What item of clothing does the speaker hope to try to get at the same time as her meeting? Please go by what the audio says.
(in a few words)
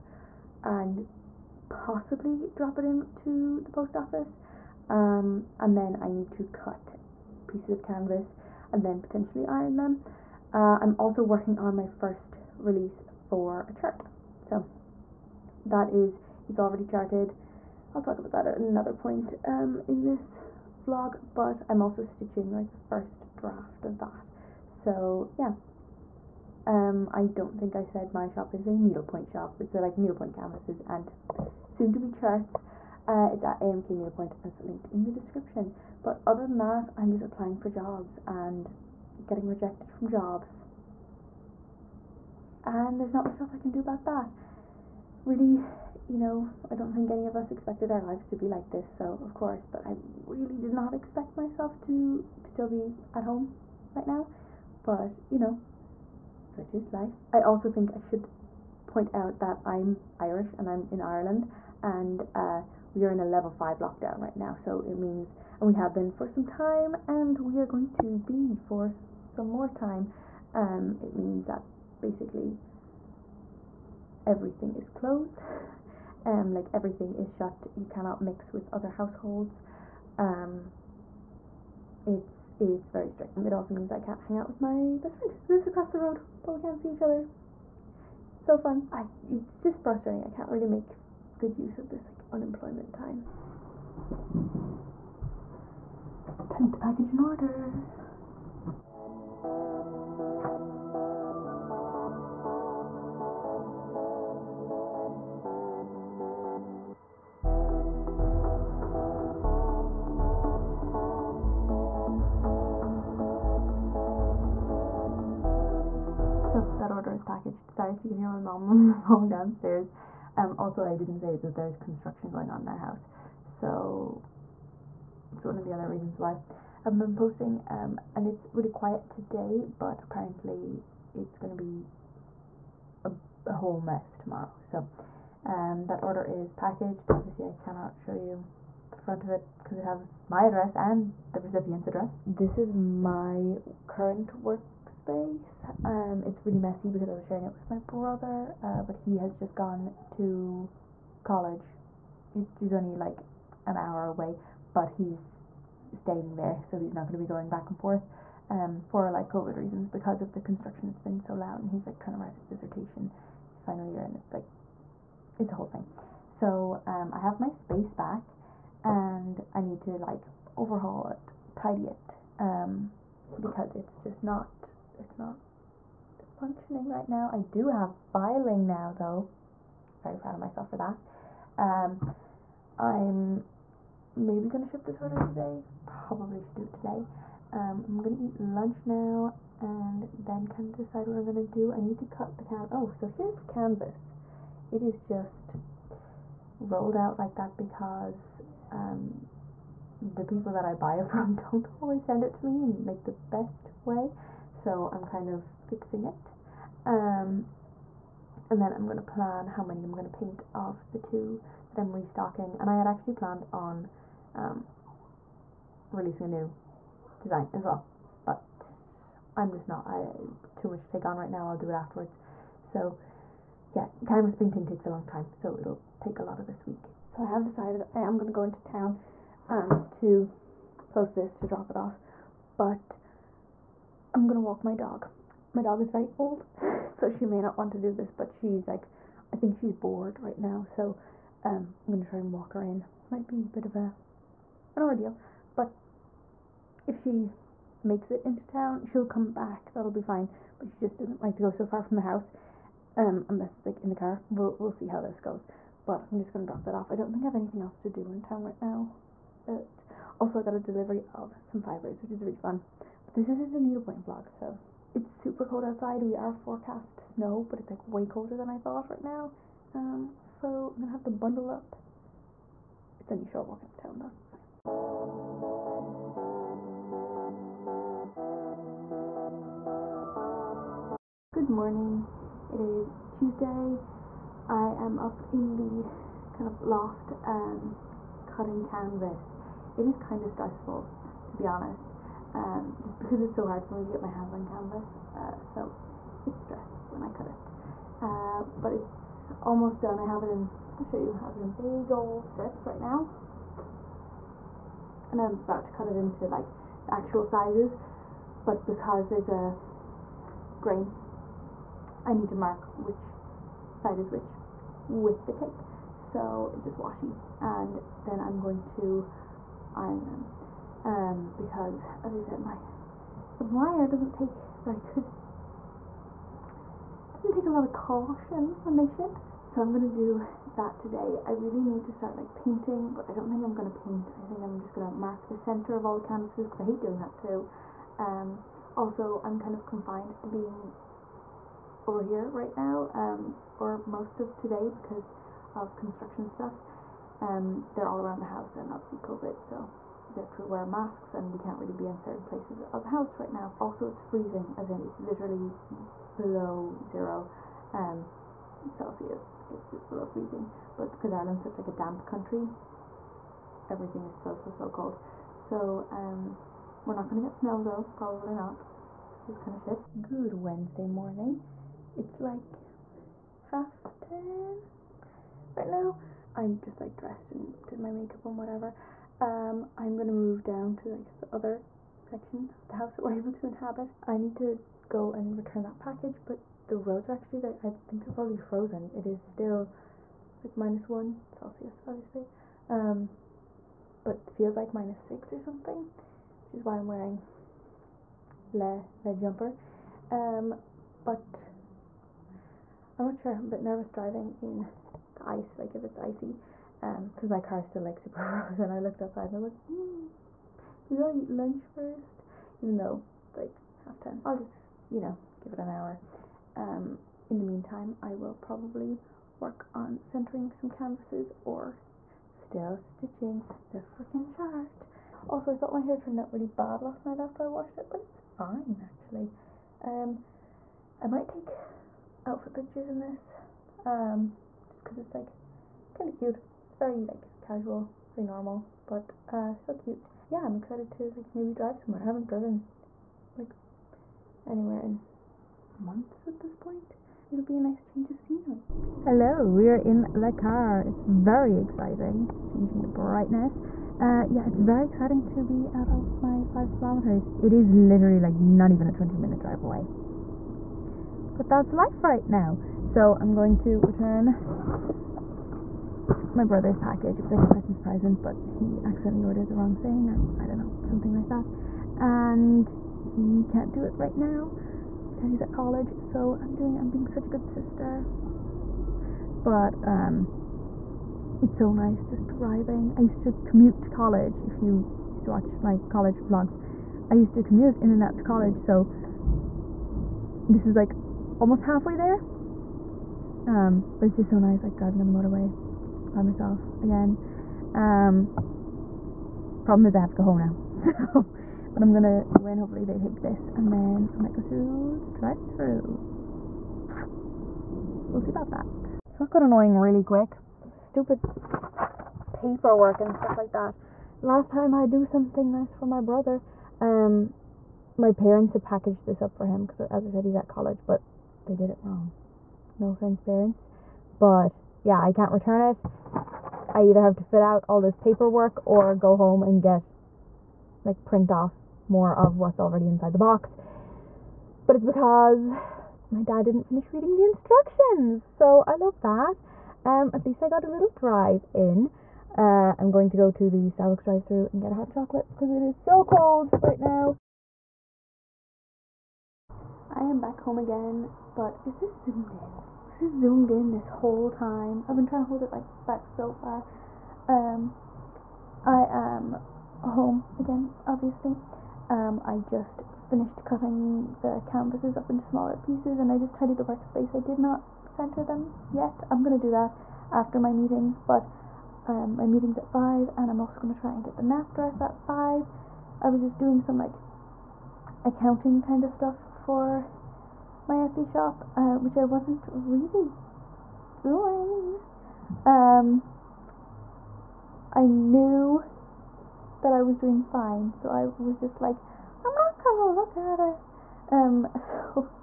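the nap dress.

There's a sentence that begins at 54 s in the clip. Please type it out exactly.
But, you know, such is life.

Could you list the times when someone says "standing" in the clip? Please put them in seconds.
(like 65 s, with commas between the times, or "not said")
not said.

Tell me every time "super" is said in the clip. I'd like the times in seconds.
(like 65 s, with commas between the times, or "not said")
265 s, 407 s.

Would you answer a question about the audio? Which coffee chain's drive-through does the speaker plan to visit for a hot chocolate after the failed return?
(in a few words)
Starbucks.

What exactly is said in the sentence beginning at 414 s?
I'll just, you know, give it an hour.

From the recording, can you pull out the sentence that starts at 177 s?
I do have filing now though.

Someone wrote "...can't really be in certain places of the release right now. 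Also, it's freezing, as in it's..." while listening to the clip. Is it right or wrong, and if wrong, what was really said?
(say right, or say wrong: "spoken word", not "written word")
wrong: "house", not "release".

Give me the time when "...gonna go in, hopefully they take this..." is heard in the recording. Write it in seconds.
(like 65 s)
501 s.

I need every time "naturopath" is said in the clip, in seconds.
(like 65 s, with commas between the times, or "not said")
not said.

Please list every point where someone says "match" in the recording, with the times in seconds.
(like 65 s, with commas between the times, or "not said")
not said.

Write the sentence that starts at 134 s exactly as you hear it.
So um, that order is packaged.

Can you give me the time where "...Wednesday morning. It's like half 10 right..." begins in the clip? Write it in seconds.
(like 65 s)
370 s.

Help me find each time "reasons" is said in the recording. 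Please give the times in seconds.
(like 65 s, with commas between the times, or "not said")
125 s, 159 s.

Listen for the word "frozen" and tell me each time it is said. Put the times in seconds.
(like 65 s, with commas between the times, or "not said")
388 s, 408 s.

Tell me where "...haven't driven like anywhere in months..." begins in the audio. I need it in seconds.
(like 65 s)
442 s.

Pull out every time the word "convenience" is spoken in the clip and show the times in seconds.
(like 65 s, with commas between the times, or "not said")
not said.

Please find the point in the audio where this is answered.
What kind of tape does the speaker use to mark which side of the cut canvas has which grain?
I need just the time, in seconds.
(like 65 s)
316 s.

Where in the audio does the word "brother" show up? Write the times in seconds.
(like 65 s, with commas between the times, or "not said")
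147 s, 466 s, 515 s.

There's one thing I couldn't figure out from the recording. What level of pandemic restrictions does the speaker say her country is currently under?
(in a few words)
Level 5.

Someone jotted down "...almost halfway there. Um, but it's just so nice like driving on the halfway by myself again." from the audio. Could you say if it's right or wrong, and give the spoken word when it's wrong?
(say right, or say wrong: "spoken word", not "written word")
wrong: "motorway", not "halfway".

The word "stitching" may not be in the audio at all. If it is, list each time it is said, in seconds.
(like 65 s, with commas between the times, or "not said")
22 s, 422 s.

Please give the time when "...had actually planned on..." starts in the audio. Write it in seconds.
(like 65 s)
212 s.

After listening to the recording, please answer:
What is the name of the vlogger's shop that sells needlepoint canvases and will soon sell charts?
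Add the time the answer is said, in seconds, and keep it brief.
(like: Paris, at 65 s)
AMK Needlepoint, at 33 s.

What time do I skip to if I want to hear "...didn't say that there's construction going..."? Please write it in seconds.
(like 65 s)
120 s.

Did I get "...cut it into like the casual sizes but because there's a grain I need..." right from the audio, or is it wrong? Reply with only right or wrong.
wrong.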